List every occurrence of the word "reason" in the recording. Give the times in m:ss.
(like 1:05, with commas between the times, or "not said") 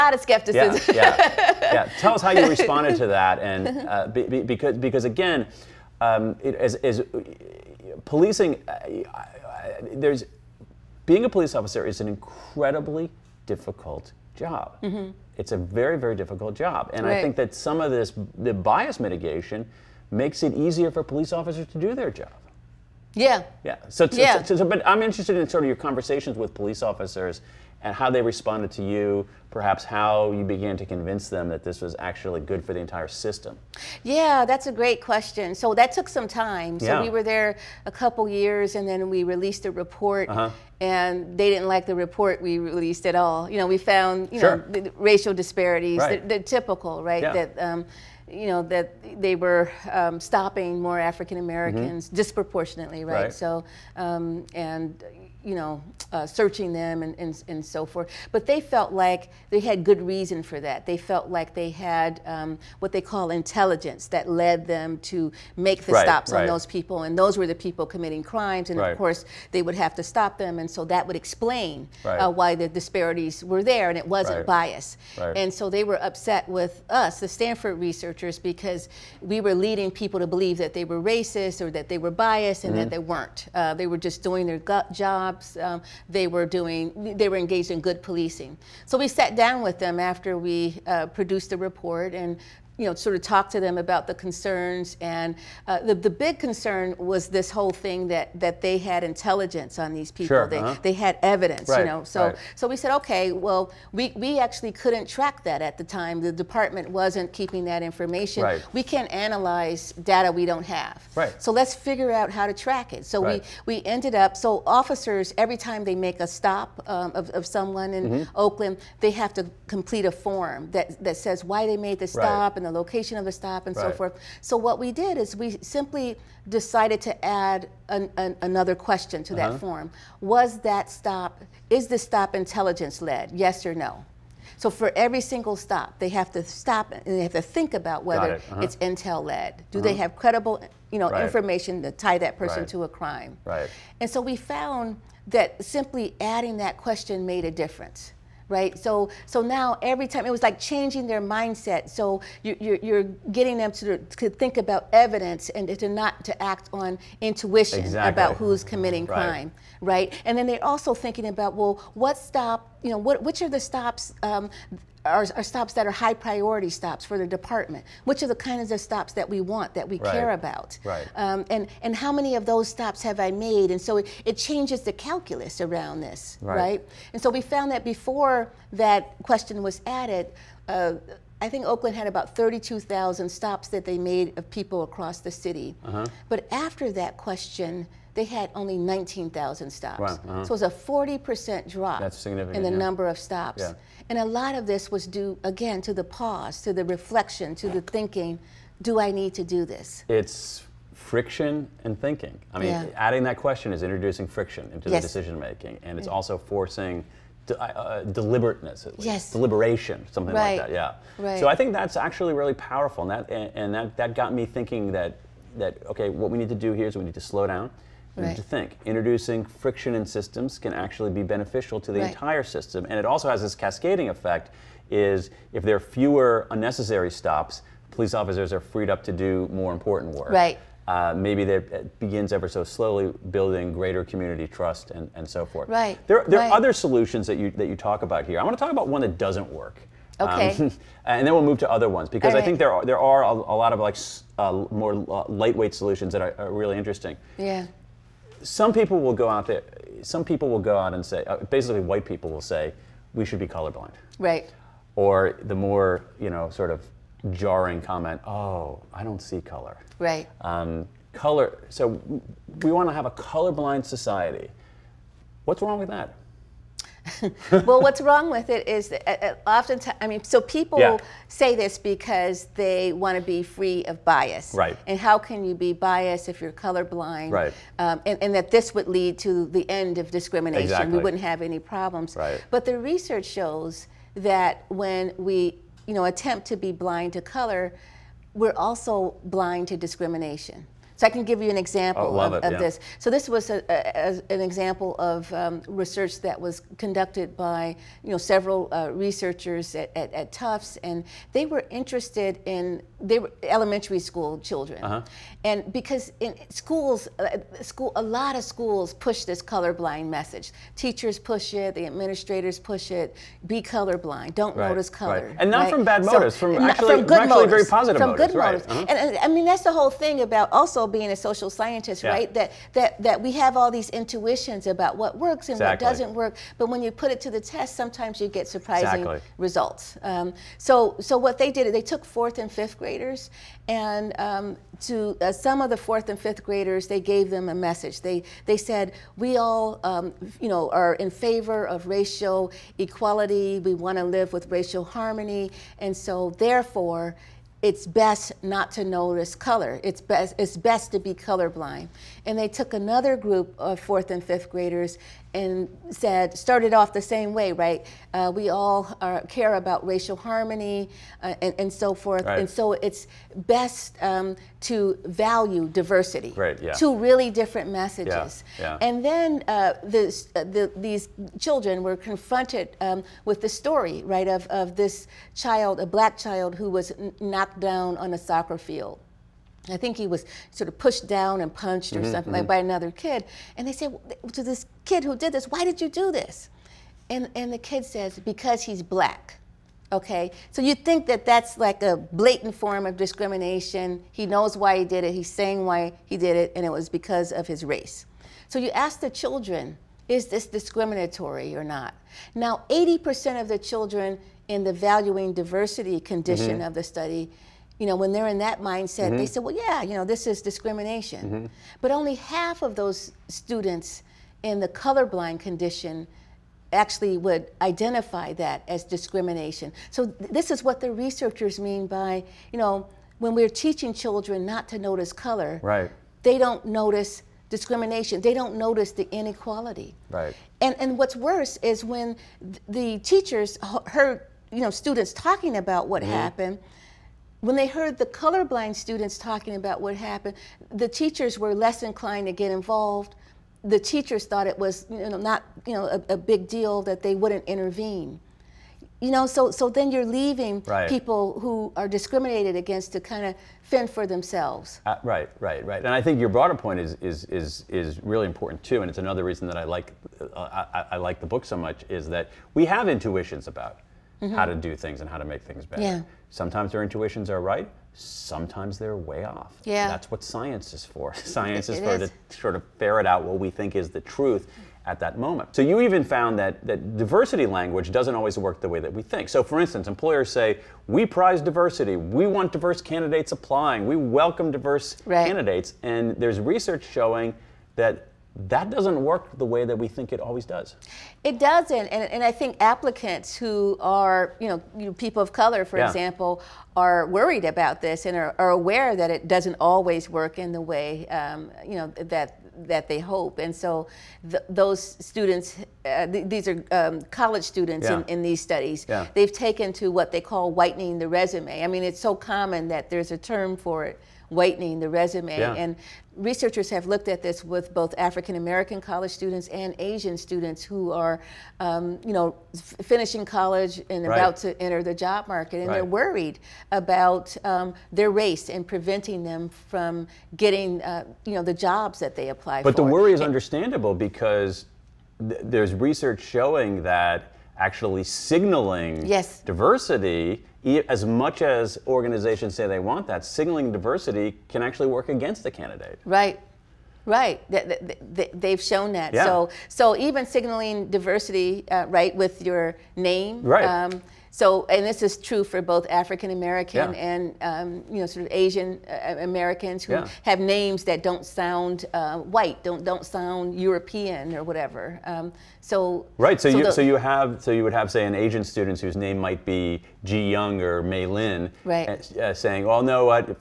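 1:00, 7:39.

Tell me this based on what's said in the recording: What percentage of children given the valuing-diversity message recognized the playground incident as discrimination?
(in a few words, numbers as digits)
80%.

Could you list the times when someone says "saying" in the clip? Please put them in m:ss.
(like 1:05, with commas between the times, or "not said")
6:35, 9:32.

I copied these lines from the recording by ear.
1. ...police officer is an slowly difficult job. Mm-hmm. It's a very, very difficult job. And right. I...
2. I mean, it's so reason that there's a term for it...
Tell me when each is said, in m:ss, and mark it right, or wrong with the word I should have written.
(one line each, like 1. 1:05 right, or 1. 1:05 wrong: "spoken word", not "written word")
1. 0:11 wrong: "incredibly", not "slowly"
2. 8:31 wrong: "common", not "reason".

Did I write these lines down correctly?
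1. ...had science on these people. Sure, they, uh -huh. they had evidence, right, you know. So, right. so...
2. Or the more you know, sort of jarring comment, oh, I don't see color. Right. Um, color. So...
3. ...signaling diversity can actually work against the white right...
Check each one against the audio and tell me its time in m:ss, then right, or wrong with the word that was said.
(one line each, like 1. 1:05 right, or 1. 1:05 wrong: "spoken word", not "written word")
1. 1:38 wrong: "intelligence", not "science"
2. 4:14 right
3. 9:03 wrong: "candidate", not "white".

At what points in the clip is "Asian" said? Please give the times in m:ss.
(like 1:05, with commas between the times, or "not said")
8:39, 9:18, 9:28.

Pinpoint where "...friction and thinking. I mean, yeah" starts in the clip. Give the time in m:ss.
3:20.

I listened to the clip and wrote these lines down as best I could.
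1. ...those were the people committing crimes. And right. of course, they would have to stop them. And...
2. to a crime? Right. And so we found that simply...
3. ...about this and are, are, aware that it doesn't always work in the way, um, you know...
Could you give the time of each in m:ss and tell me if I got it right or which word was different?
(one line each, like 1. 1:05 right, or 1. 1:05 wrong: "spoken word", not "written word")
1. 1:07 right
2. 2:22 right
3. 8:17 right.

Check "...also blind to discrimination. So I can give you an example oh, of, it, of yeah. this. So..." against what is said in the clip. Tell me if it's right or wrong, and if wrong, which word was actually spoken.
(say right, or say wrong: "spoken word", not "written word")
right.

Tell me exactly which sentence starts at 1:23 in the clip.
Uh, they were just doing their job um, they were doing, they were engaged in good policing.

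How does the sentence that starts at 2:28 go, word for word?
So so now every time it was like changing their mindset.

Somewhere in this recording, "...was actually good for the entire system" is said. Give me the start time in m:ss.
0:31.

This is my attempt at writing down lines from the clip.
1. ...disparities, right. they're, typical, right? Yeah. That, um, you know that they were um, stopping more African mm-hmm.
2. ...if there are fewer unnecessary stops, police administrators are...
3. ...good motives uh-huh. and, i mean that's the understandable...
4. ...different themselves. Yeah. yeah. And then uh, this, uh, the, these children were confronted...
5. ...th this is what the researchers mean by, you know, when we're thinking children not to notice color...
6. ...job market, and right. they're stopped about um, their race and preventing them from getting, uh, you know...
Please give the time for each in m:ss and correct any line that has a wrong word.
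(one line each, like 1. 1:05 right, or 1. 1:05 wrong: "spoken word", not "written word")
1. 0:45 right
2. 3:45 wrong: "officers", not "administrators"
3. 5:18 wrong: "whole", not "understandable"
4. 6:07 wrong: "messages", not "themselves"
5. 7:00 wrong: "teaching", not "thinking"
6. 8:44 wrong: "worried", not "stopped".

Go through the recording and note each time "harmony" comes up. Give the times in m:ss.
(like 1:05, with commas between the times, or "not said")
5:44, 6:00.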